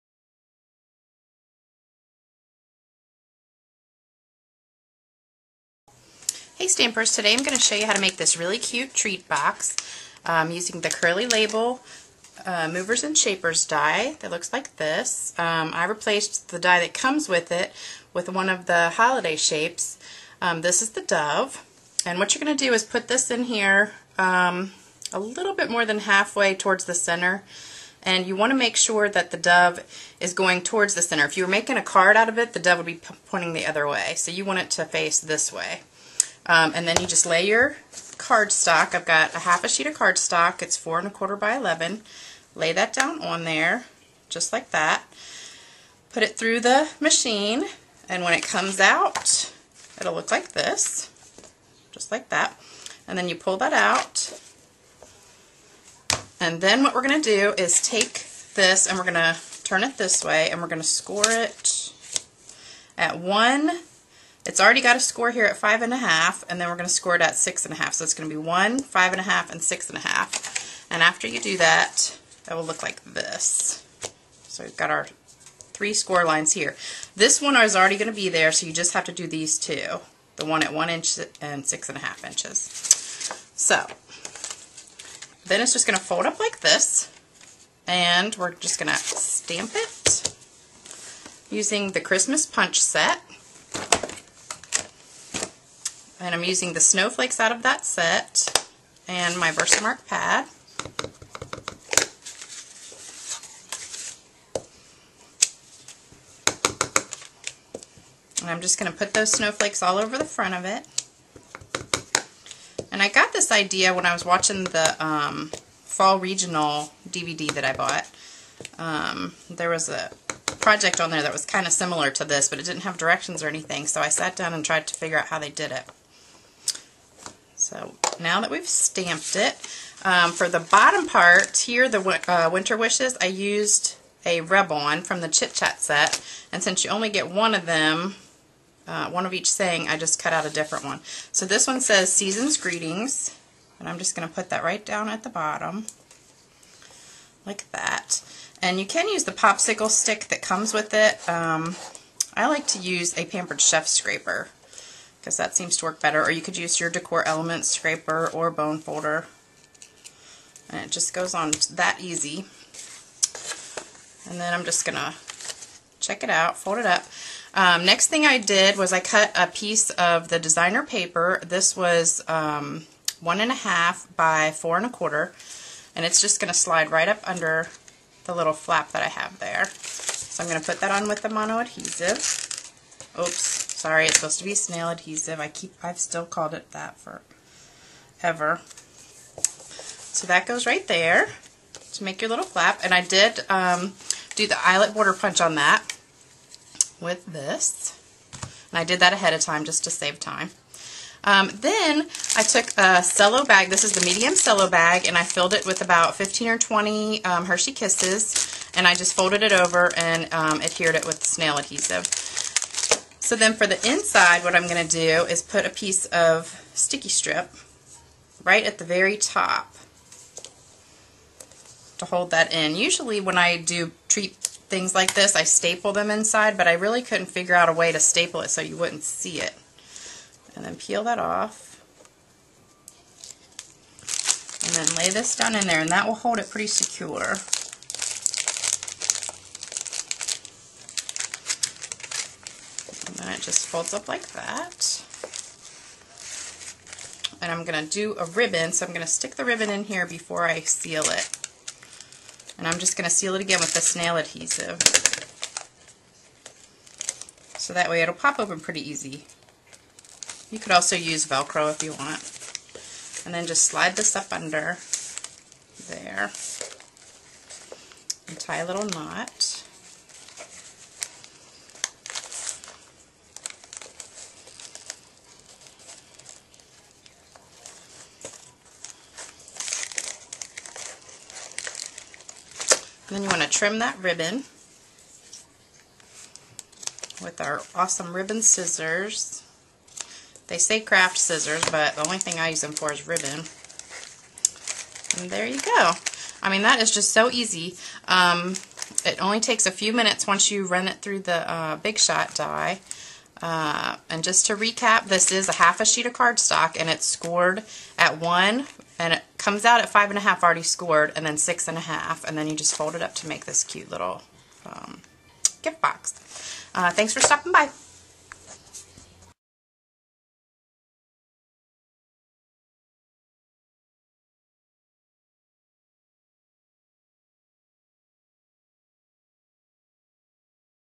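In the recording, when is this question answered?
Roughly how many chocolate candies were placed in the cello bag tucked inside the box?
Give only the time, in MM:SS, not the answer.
03:26.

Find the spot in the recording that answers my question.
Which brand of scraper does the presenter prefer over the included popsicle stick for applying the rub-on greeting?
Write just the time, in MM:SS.
02:33.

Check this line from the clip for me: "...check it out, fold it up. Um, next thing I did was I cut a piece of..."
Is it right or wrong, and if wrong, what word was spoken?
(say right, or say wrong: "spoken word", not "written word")
right.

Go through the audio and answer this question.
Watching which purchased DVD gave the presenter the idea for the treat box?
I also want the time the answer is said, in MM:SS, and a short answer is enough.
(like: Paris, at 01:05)
Fall Regional DVD, at 01:55.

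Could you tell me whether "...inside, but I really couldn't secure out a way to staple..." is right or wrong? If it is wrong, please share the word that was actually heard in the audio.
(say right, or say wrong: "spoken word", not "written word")
wrong: "figure", not "secure".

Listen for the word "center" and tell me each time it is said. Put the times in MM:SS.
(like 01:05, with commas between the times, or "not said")
00:26, 00:31.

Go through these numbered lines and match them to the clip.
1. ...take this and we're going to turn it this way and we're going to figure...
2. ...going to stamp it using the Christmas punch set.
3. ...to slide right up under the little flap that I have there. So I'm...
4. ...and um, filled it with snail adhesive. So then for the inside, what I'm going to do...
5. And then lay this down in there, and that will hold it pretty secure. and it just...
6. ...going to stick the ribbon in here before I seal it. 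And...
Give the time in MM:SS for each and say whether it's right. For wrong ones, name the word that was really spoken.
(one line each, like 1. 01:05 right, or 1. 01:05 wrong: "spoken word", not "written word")
1. 00:57 wrong: "score", not "figure"
2. 01:28 right
3. 02:56 right
4. 03:29 wrong: "adhered", not "filled"
5. 03:54 right
6. 04:08 right.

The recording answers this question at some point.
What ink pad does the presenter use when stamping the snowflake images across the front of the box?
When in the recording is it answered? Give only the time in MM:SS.
01:39.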